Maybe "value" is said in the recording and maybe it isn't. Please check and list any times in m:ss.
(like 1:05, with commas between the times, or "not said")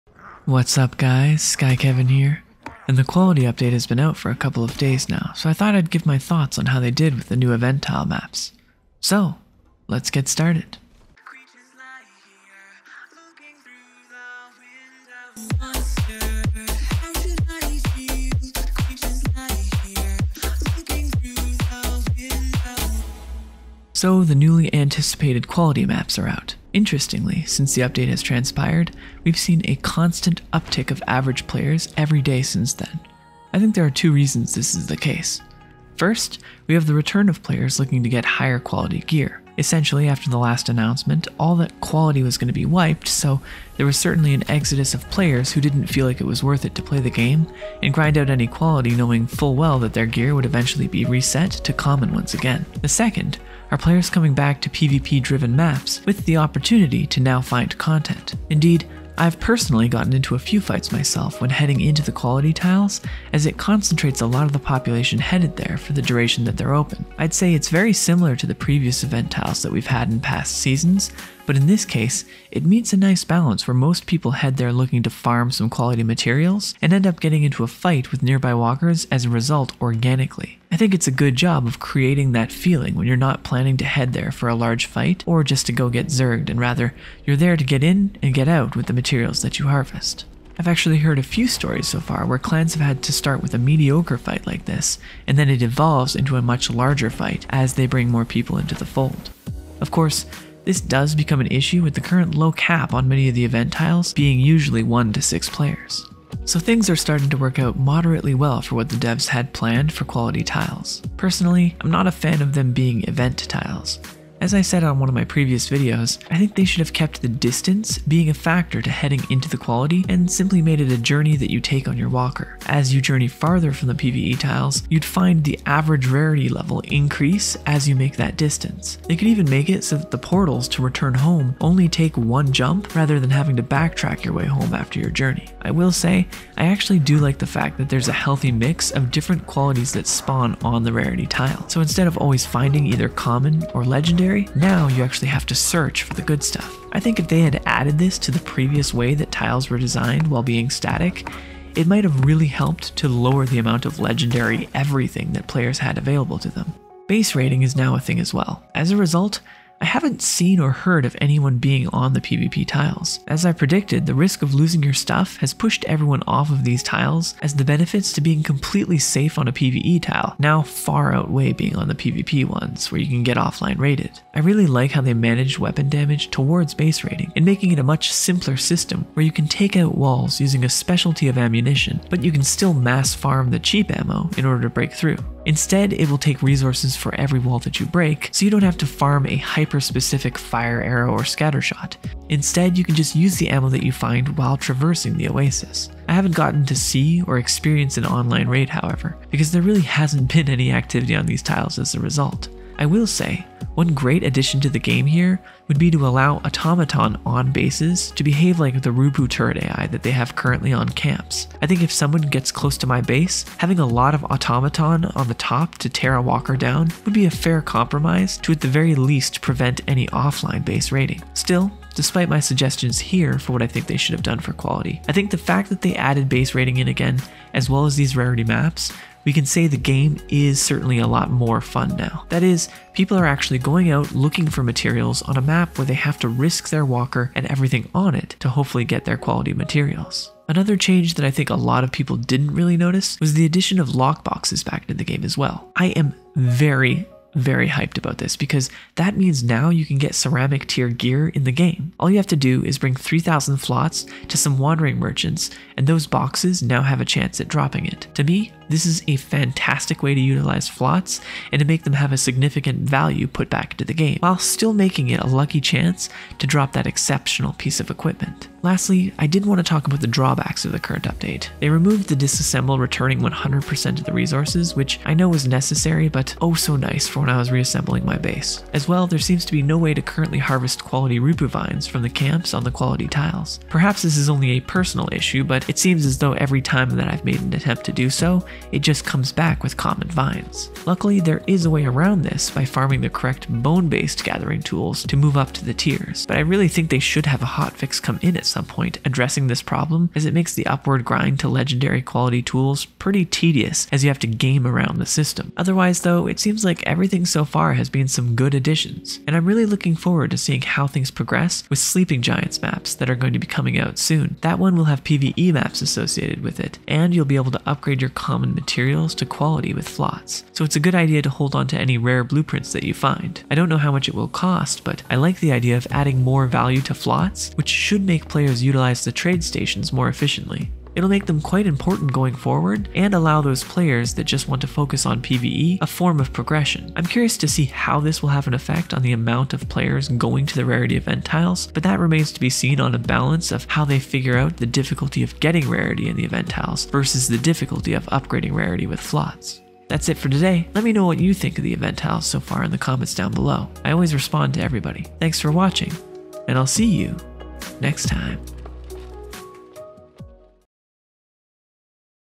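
4:22, 5:26.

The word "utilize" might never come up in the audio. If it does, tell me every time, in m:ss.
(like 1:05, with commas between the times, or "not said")
4:20, 5:28.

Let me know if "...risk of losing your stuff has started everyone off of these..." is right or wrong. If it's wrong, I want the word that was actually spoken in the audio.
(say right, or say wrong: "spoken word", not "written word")
wrong: "pushed", not "started".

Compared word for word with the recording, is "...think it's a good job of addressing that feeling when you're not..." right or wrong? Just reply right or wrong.
wrong.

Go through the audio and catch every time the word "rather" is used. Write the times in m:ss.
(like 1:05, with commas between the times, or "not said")
1:26, 2:12.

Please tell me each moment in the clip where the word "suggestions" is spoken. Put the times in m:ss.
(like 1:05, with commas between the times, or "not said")
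3:42.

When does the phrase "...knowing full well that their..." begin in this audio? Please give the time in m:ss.
0:48.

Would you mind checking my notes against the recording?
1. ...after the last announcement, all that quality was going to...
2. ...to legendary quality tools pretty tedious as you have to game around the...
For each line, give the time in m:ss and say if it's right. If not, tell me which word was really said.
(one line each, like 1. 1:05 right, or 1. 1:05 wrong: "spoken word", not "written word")
1. 0:40 right
2. 5:01 right.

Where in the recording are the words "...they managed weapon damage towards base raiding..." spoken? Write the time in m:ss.
2:55.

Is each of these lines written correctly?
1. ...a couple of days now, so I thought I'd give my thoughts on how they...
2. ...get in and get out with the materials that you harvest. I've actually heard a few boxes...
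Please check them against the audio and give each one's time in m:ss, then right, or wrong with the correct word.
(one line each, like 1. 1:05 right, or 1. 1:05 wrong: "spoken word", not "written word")
1. 0:04 right
2. 1:27 wrong: "stories", not "boxes".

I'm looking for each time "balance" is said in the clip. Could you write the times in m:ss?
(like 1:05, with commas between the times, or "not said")
1:13, 5:42.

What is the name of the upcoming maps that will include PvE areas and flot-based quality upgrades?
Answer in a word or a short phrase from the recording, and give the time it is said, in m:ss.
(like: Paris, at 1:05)
Sleeping Giants, at 5:11.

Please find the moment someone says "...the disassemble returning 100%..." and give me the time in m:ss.
4:32.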